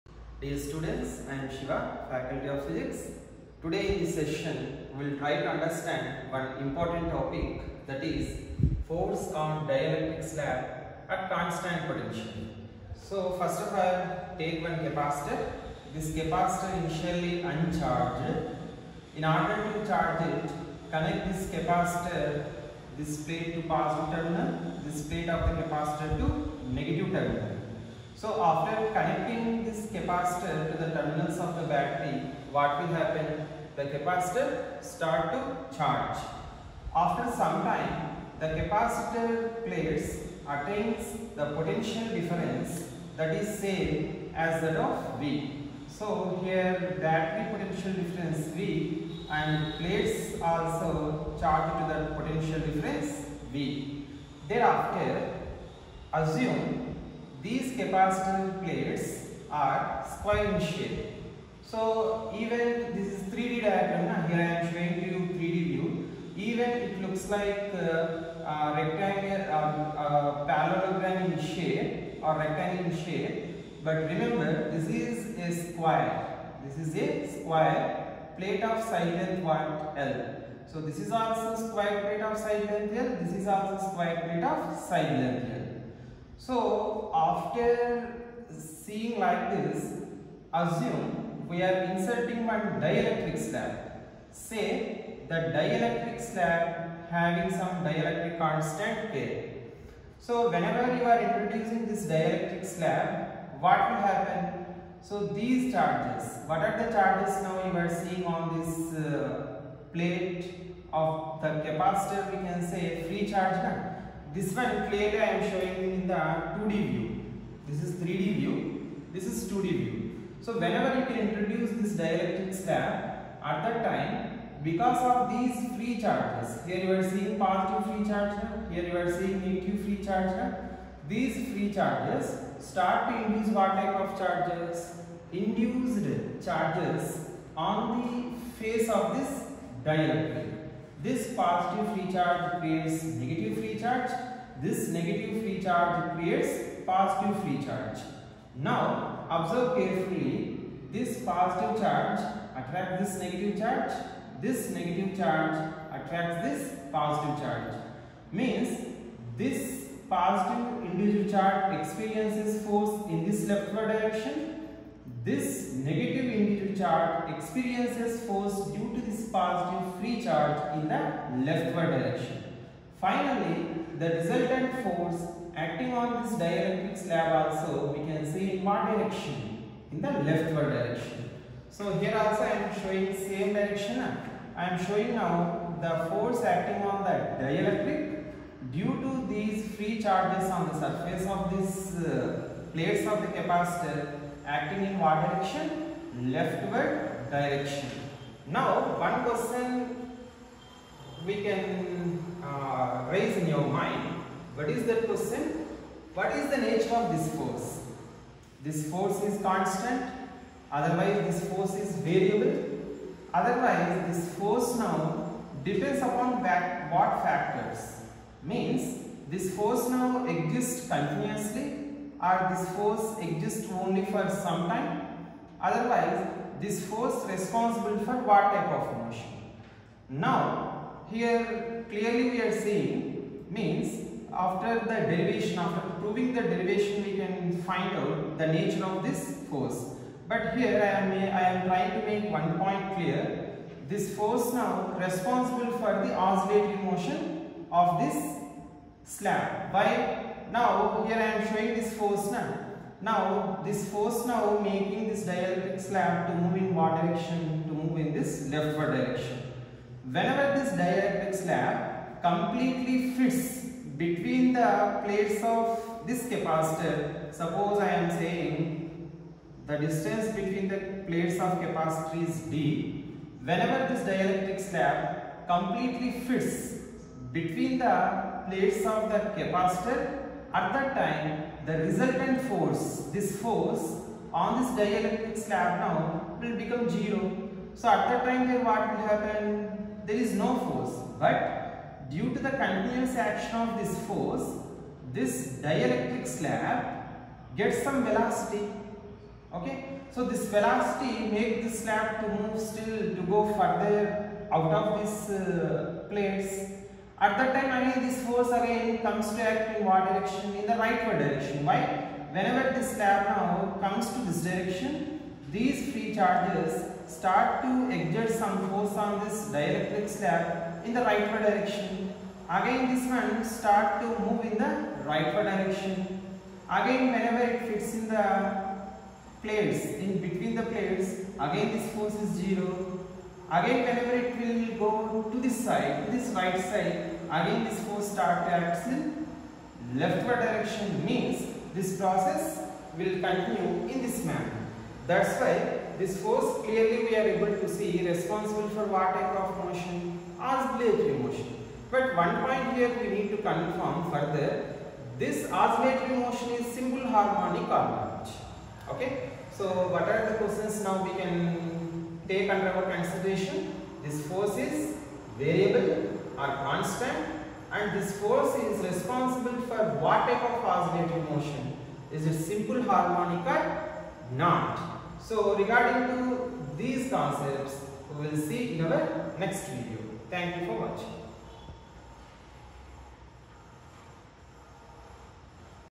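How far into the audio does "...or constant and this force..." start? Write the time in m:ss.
6:06.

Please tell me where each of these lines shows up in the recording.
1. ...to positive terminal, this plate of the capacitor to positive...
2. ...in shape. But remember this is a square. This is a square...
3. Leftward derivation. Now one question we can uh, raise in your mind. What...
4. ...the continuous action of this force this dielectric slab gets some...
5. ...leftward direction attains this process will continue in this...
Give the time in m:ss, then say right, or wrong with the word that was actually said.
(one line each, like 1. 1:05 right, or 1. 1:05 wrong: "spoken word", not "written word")
1. 0:23 wrong: "negative", not "positive"
2. 1:12 right
3. 3:16 wrong: "direction", not "derivation"
4. 4:52 right
5. 5:39 wrong: "means", not "attains".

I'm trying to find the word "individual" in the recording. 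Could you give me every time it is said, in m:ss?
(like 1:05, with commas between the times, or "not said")
2:40, 2:46.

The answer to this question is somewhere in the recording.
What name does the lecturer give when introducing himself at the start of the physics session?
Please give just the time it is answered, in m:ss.
0:01.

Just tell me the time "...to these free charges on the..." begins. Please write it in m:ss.
3:09.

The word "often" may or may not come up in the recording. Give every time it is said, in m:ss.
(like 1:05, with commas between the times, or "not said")
not said.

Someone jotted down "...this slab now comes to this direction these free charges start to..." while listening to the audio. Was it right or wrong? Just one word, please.
right.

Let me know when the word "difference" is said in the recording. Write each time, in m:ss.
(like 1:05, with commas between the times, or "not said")
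0:42, 0:48, 0:52.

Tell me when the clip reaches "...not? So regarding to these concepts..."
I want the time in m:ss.
6:14.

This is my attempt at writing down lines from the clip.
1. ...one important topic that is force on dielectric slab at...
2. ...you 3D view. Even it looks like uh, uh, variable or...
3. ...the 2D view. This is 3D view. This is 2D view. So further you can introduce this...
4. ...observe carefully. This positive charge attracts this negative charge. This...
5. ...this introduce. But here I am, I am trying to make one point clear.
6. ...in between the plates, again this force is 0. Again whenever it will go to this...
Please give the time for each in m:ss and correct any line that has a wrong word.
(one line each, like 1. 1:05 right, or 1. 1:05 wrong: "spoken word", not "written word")
1. 0:06 right
2. 1:05 wrong: "rectangle", not "variable"
3. 1:56 wrong: "whenever", not "further"
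4. 2:29 right
5. 3:59 wrong: "force", not "introduce"
6. 5:29 right.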